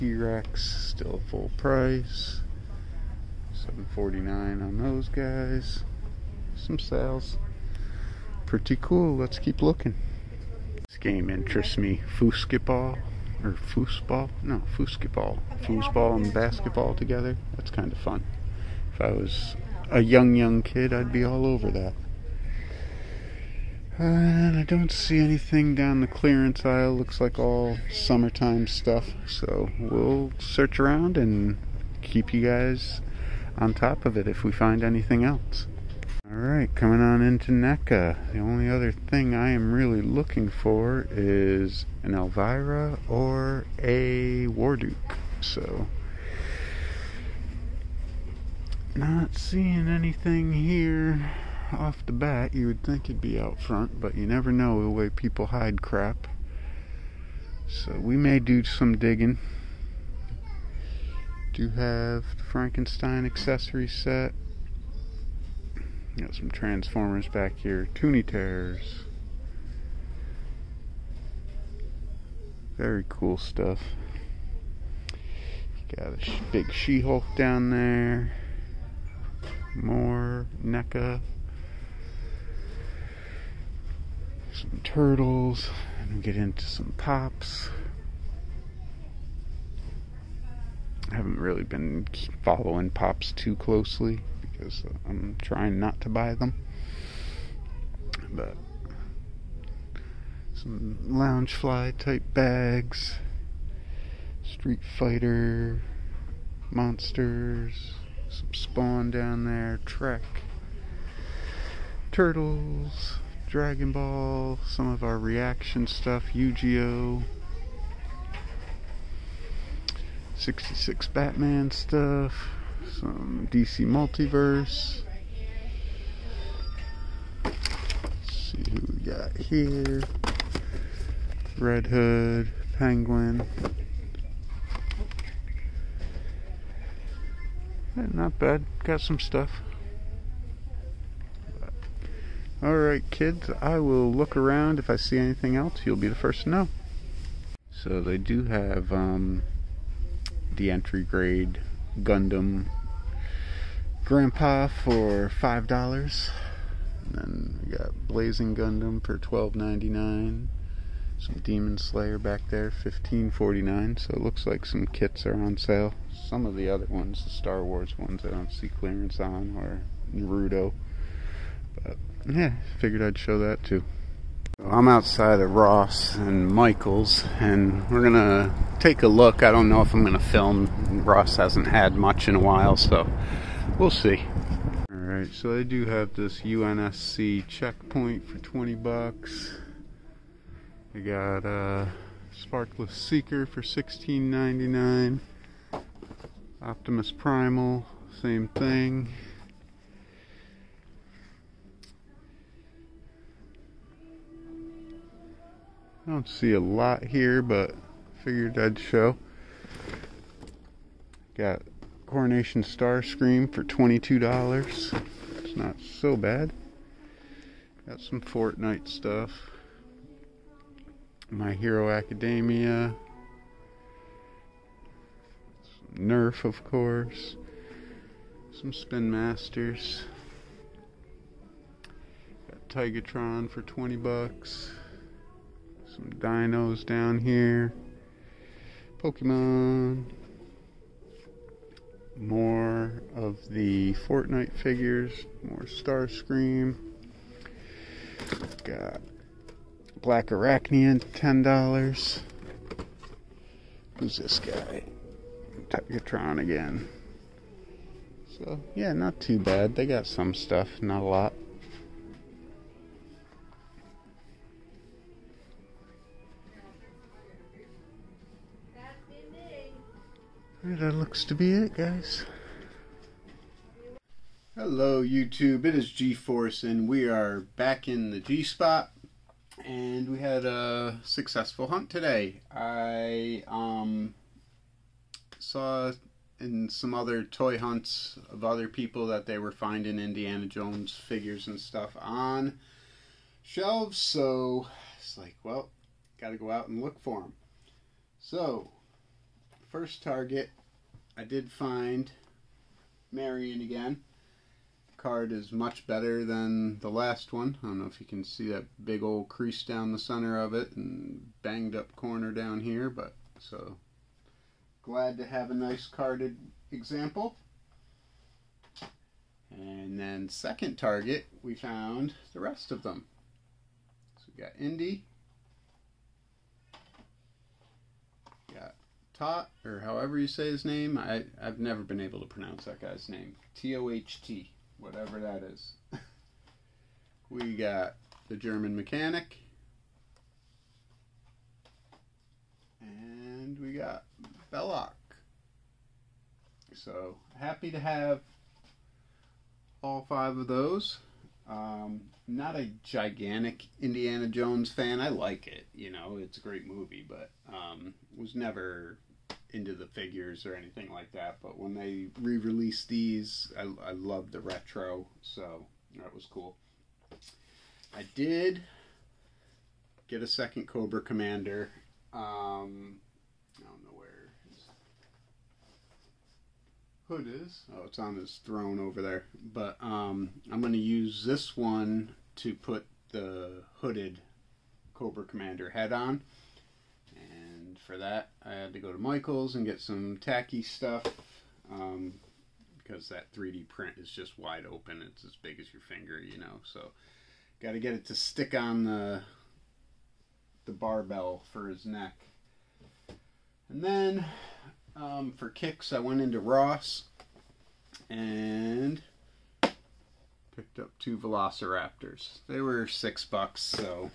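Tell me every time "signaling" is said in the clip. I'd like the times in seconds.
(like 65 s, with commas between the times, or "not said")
not said.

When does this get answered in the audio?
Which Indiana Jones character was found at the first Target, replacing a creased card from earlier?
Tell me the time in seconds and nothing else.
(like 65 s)
303 s.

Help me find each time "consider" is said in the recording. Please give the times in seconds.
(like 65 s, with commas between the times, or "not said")
not said.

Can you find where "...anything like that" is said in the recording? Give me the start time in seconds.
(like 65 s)
360 s.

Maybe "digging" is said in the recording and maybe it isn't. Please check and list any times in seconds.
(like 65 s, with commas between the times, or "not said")
58 s.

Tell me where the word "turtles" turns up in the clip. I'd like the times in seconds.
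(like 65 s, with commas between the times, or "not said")
84 s, 112 s.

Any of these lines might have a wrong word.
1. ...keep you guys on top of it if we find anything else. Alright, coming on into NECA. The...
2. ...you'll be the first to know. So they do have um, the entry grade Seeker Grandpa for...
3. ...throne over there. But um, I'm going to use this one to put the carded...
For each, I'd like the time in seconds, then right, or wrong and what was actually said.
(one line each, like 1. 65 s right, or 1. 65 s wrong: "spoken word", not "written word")
1. 31 s right
2. 145 s wrong: "Gundam", not "Seeker"
3. 378 s wrong: "hooded", not "carded".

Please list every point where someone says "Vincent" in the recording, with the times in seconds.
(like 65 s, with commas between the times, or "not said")
not said.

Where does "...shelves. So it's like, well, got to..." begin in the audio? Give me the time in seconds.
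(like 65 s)
293 s.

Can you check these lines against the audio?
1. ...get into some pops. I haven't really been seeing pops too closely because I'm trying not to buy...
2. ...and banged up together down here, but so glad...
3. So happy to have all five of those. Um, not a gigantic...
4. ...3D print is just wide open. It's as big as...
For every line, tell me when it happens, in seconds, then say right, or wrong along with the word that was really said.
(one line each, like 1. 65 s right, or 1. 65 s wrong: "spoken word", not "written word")
1. 86 s wrong: "following", not "seeing"
2. 310 s wrong: "corner", not "together"
3. 346 s right
4. 393 s right.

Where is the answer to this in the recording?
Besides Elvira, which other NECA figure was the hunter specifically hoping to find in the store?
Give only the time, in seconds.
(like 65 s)
44 s.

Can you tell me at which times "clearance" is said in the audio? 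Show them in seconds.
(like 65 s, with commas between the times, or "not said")
26 s, 168 s.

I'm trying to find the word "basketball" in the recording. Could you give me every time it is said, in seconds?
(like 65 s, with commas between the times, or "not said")
16 s.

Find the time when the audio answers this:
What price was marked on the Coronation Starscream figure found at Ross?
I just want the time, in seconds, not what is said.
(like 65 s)
213 s.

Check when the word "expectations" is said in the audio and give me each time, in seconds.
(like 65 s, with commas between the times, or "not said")
not said.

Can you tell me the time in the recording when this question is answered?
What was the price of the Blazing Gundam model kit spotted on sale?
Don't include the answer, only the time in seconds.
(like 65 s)
159 s.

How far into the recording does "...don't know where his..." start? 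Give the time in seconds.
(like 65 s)
373 s.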